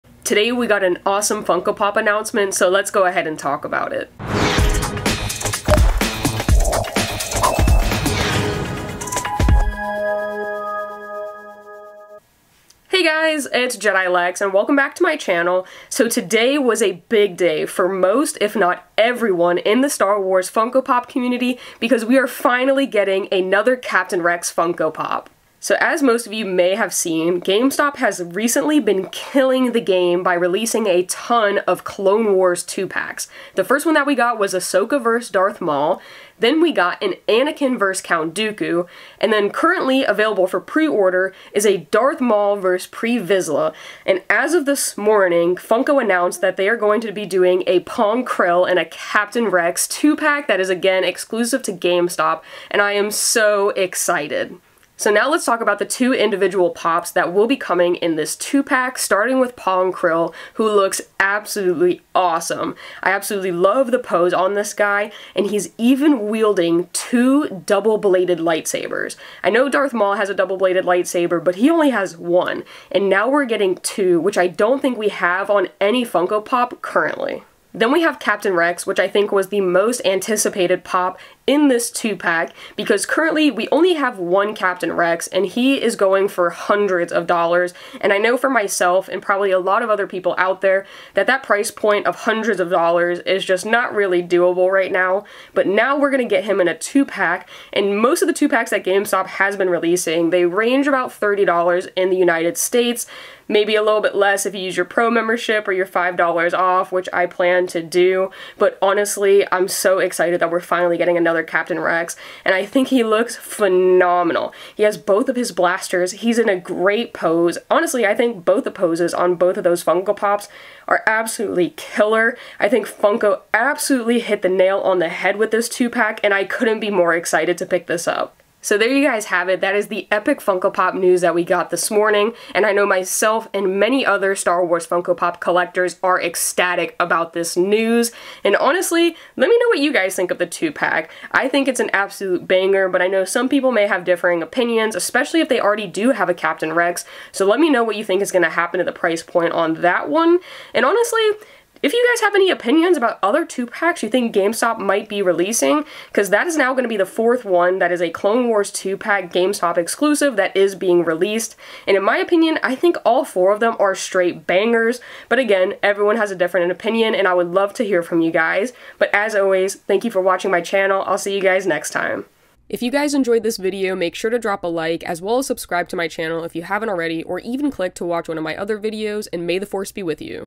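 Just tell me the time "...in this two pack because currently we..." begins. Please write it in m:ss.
1:21.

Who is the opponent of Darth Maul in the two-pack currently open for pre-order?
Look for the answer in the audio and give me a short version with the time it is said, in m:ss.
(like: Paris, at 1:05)
Pre Vizsla, at 0:42.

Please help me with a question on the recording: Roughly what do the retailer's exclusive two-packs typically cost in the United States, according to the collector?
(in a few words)
$30.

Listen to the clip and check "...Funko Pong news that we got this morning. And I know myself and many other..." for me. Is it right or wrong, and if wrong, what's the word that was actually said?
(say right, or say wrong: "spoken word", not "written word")
wrong: "Pop", not "Pong".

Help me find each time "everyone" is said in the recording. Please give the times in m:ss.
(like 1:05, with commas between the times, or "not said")
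0:18, 2:45.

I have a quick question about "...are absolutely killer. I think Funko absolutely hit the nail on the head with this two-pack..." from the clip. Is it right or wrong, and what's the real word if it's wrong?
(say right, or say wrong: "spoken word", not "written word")
right.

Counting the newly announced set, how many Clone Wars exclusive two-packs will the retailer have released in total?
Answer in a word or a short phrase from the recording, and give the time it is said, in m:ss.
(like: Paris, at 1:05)
4, at 2:37.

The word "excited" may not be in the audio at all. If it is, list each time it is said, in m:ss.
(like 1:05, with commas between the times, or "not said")
0:53, 1:49, 2:07.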